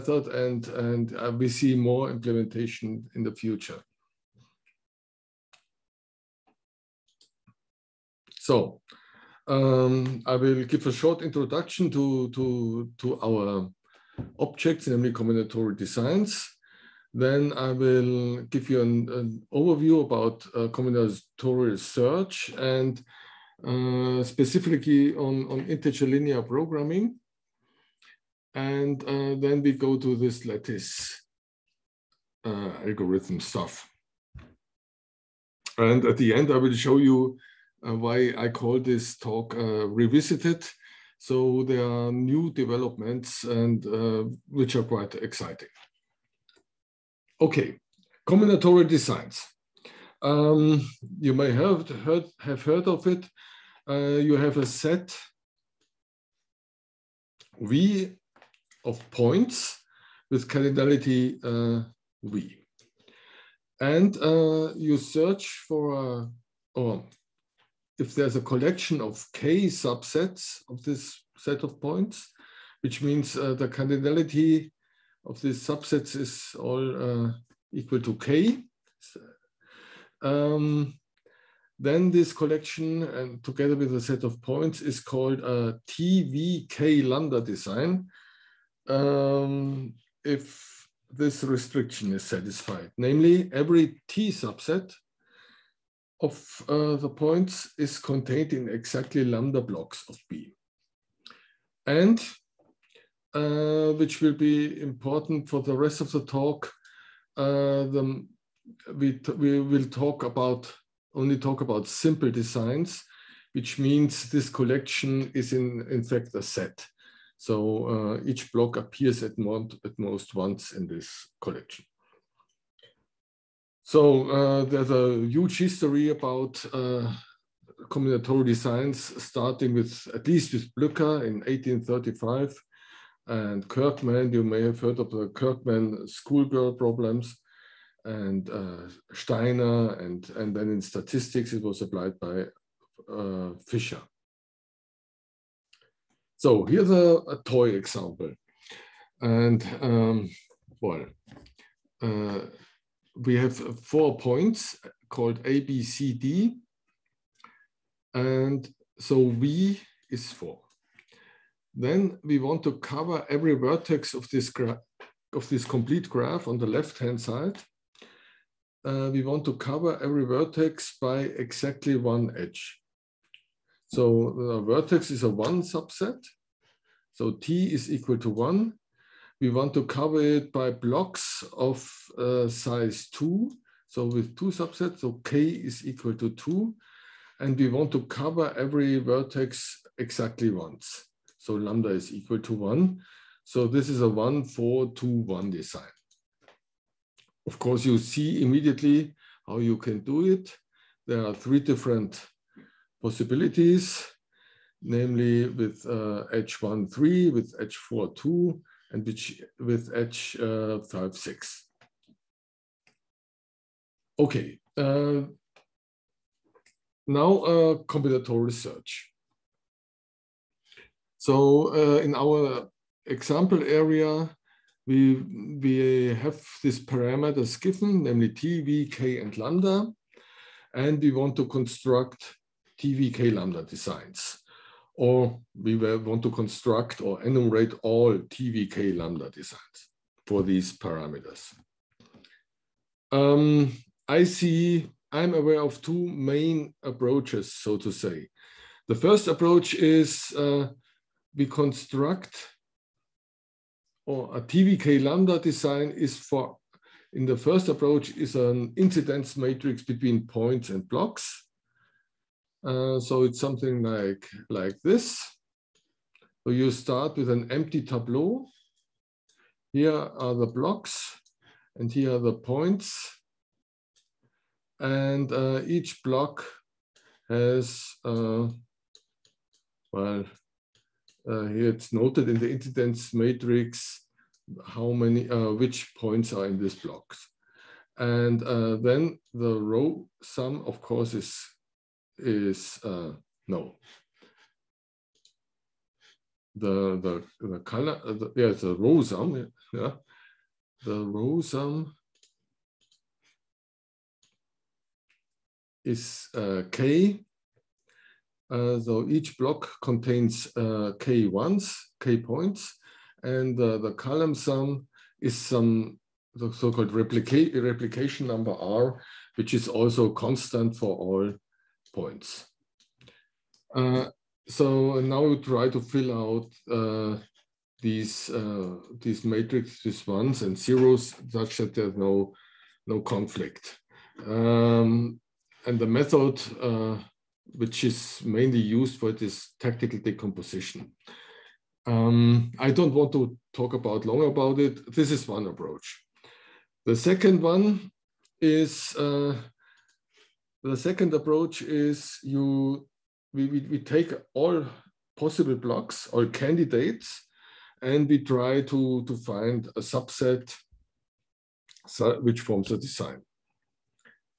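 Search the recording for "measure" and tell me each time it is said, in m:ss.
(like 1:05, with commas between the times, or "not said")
not said.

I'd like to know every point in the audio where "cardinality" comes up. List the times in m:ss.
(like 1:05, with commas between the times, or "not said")
1:00, 1:13.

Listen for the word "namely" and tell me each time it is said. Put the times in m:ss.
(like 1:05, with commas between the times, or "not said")
0:14, 1:32, 3:24, 3:48.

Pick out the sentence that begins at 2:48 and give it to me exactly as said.
Uh, we want to cover every vertex by exactly one edge.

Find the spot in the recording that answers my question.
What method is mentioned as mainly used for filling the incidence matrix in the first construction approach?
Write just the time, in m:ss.
5:39.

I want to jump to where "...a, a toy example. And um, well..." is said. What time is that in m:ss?
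2:26.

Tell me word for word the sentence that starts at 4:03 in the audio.
Um, I see, I'm aware of two main approaches, so to say.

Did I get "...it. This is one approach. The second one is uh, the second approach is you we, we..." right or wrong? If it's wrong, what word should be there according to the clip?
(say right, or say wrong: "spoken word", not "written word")
right.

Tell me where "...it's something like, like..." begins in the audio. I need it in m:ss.
4:23.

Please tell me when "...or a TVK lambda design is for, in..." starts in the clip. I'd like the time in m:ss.
4:14.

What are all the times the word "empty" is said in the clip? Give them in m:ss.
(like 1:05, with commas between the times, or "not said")
4:27.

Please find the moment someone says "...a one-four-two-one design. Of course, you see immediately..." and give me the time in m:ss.
3:14.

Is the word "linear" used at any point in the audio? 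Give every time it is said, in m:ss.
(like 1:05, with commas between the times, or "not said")
0:26.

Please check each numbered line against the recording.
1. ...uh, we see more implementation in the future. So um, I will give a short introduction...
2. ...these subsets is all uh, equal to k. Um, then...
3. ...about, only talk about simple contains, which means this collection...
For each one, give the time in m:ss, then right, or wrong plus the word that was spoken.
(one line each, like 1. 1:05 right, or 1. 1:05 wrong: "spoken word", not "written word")
1. 0:01 right
2. 1:15 right
3. 1:50 wrong: "designs", not "contains".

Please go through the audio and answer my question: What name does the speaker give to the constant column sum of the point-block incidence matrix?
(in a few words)
replication number.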